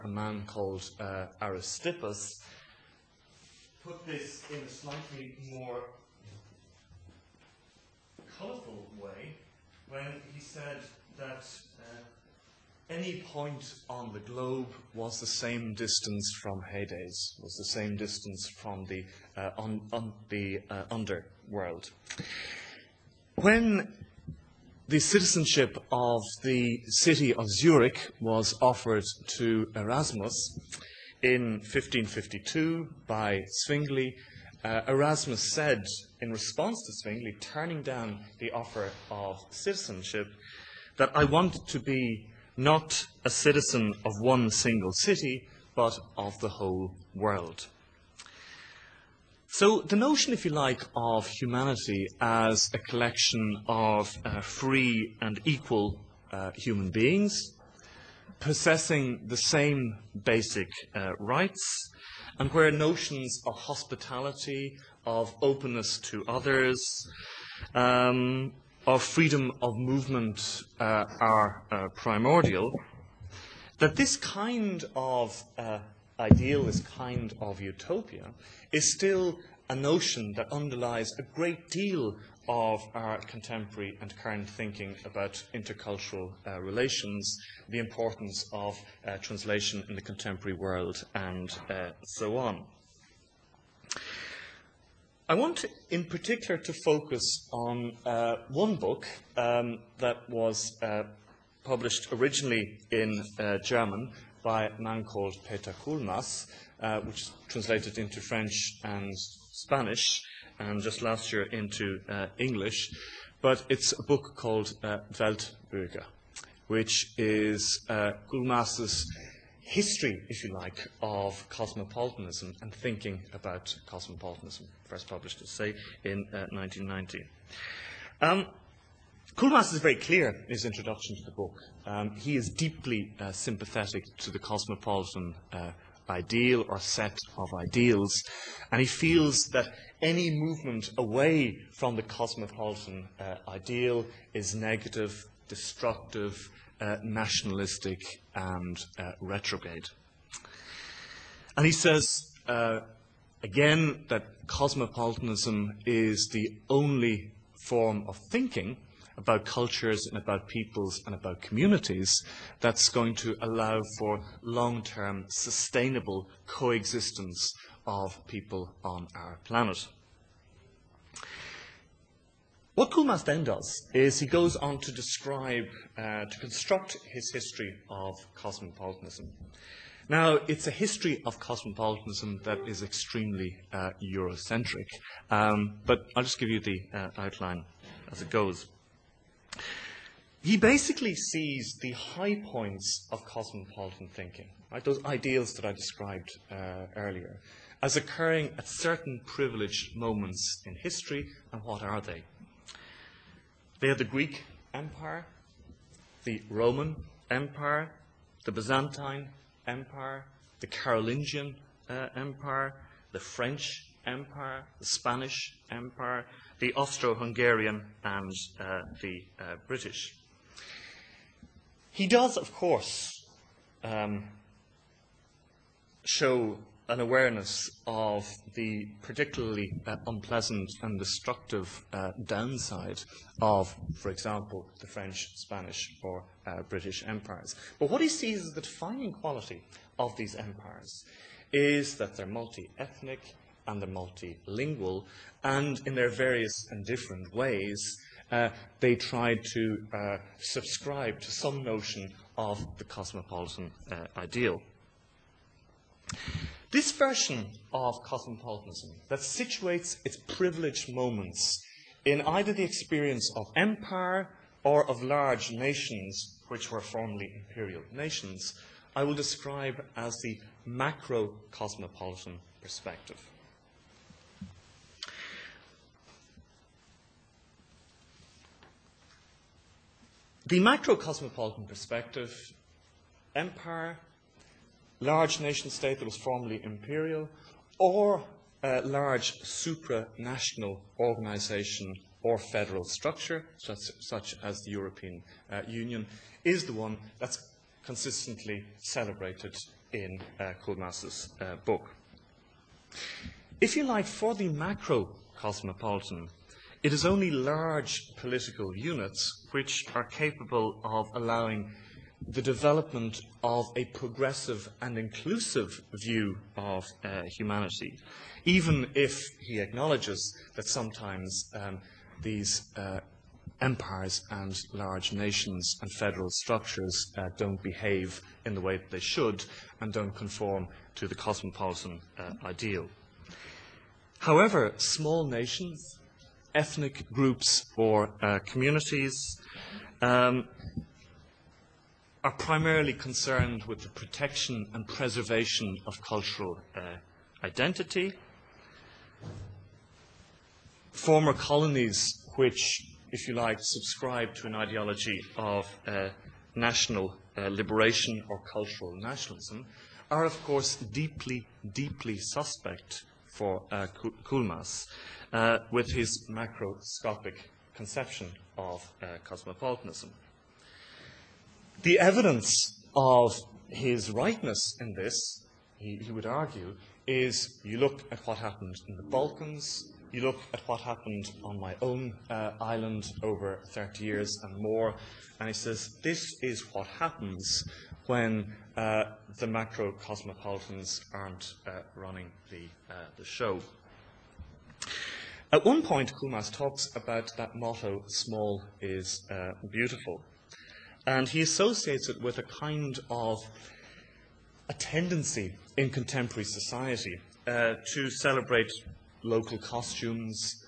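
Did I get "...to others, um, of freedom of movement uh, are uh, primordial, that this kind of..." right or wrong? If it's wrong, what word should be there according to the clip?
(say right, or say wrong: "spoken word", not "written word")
right.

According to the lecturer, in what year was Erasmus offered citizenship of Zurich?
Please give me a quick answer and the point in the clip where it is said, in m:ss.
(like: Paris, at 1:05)
1552, at 0:31.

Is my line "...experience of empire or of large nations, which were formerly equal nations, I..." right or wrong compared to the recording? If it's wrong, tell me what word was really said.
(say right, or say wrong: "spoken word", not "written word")
wrong: "imperial", not "equal".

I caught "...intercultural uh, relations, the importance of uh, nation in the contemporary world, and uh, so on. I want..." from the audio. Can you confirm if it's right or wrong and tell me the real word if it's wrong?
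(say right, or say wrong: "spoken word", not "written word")
wrong: "translation", not "nation".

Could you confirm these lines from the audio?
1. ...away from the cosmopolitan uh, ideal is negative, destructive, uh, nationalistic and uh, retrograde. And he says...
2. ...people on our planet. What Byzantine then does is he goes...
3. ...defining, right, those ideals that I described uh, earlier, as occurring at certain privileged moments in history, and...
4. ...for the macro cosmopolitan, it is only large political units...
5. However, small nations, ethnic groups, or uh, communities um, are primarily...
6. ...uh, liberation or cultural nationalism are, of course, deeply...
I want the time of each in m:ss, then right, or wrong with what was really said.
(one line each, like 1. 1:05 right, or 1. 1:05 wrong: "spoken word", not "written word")
1. 2:20 right
2. 2:48 wrong: "Coulmas", not "Byzantine"
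3. 3:14 wrong: "thinking", not "defining"
4. 5:04 right
5. 5:34 right
6. 5:57 right.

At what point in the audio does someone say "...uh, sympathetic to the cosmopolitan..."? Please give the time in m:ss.
2:13.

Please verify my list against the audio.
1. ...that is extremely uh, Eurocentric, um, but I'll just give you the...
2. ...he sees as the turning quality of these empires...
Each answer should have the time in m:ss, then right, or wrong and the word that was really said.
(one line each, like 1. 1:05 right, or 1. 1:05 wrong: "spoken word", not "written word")
1. 3:02 right
2. 3:58 wrong: "defining", not "turning".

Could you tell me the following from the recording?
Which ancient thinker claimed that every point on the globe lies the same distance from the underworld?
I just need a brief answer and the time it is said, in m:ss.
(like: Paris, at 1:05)
Aristippus, at 0:01.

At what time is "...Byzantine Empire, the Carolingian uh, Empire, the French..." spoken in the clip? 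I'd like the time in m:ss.
3:28.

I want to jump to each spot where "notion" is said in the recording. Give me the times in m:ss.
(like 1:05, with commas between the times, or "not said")
0:49, 1:02, 1:19, 4:11.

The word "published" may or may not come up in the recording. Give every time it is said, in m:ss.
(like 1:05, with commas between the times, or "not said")
1:41, 2:05.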